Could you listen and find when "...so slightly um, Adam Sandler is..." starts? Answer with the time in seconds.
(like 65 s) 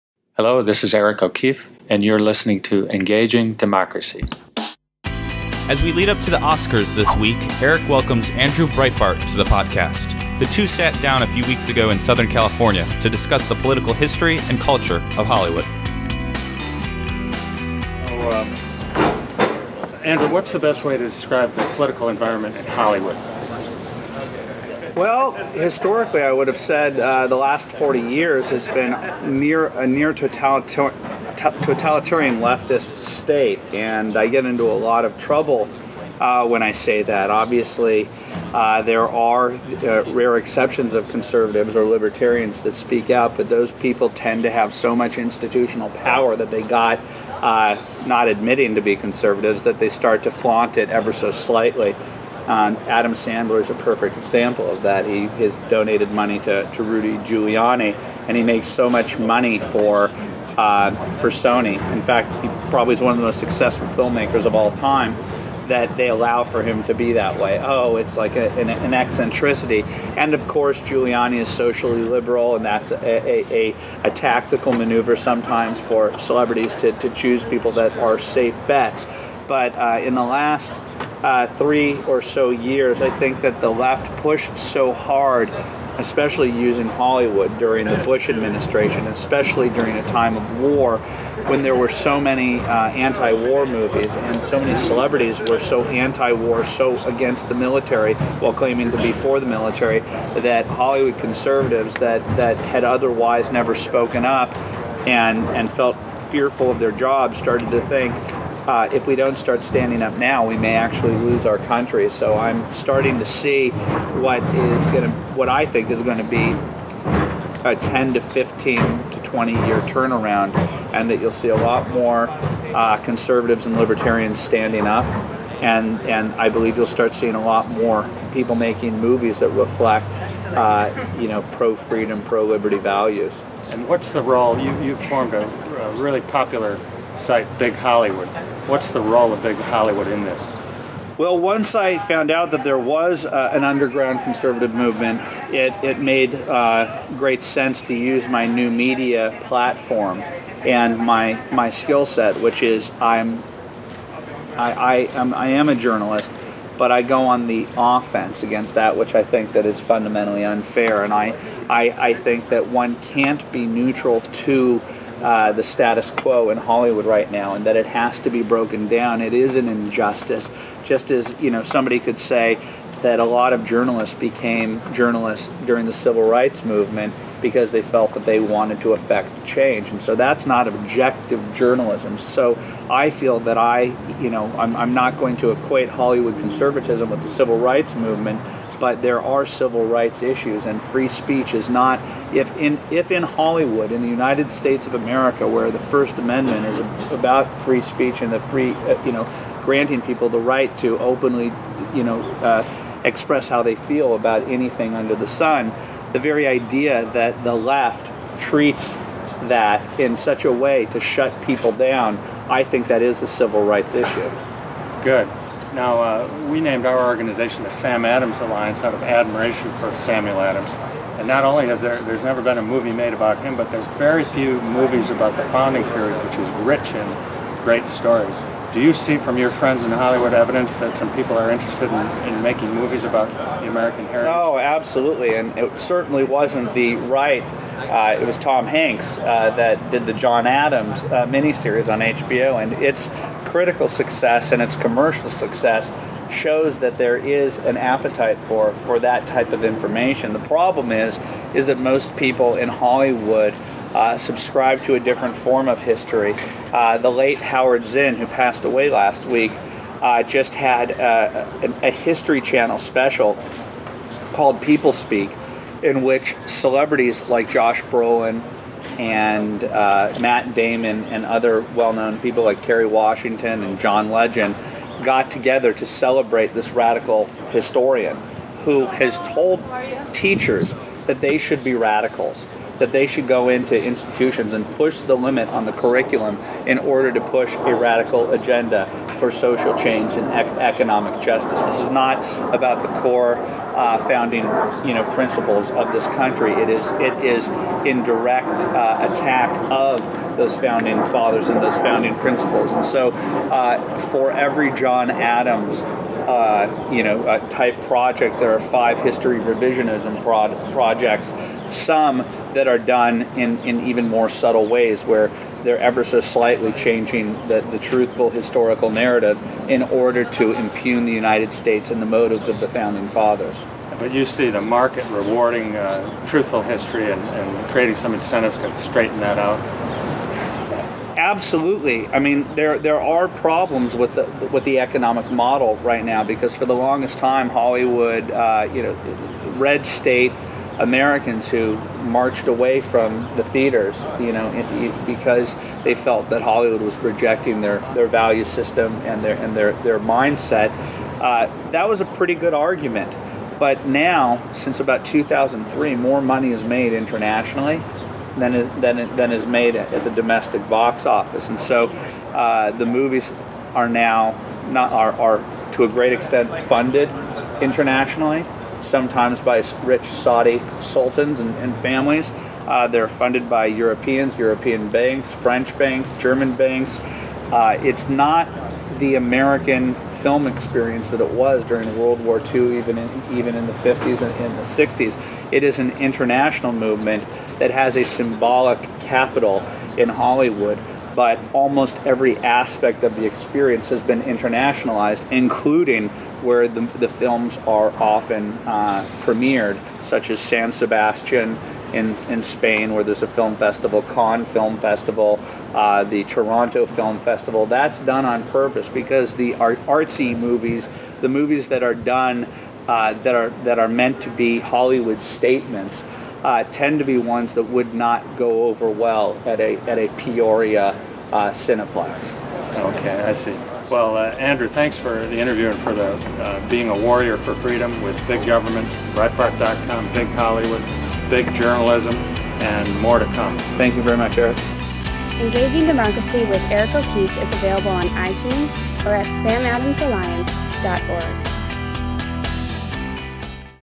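51 s.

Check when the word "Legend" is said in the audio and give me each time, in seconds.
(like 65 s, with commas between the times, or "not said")
274 s.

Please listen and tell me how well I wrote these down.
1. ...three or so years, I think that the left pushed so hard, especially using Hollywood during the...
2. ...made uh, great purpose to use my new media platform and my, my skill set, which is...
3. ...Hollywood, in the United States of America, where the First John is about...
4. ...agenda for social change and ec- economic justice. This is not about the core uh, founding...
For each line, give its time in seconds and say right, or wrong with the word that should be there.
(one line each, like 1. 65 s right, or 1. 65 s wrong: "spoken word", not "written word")
1. 81 s right
2. 145 s wrong: "sense", not "purpose"
3. 193 s wrong: "Amendment", not "John"
4. 288 s right.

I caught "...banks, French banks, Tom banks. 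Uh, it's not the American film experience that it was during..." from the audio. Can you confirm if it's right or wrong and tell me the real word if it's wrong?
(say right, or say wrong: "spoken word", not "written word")
wrong: "German", not "Tom".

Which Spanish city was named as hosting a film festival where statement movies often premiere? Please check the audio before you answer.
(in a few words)
San Sebastian.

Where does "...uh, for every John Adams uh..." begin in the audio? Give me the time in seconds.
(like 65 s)
303 s.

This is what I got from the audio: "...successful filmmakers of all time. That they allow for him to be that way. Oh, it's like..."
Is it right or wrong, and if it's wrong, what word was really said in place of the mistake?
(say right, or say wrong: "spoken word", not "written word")
right.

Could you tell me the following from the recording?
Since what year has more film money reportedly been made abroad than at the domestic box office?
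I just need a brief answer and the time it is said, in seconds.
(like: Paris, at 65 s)
2003, at 355 s.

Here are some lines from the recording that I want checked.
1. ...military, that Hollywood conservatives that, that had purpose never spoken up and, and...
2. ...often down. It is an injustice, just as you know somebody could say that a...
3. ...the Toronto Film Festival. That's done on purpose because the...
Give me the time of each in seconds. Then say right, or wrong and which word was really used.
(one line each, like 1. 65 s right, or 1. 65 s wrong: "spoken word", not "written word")
1. 99 s wrong: "otherwise", not "purpose"
2. 168 s wrong: "broken", not "often"
3. 406 s right.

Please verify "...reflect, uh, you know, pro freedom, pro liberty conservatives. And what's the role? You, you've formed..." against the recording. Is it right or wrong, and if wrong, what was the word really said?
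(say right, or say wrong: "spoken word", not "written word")
wrong: "values", not "conservatives".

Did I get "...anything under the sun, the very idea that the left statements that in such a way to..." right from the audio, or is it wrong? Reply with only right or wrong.
wrong.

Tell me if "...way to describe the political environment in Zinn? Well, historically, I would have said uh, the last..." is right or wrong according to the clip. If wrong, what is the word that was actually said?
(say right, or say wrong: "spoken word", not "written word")
wrong: "Hollywood", not "Zinn".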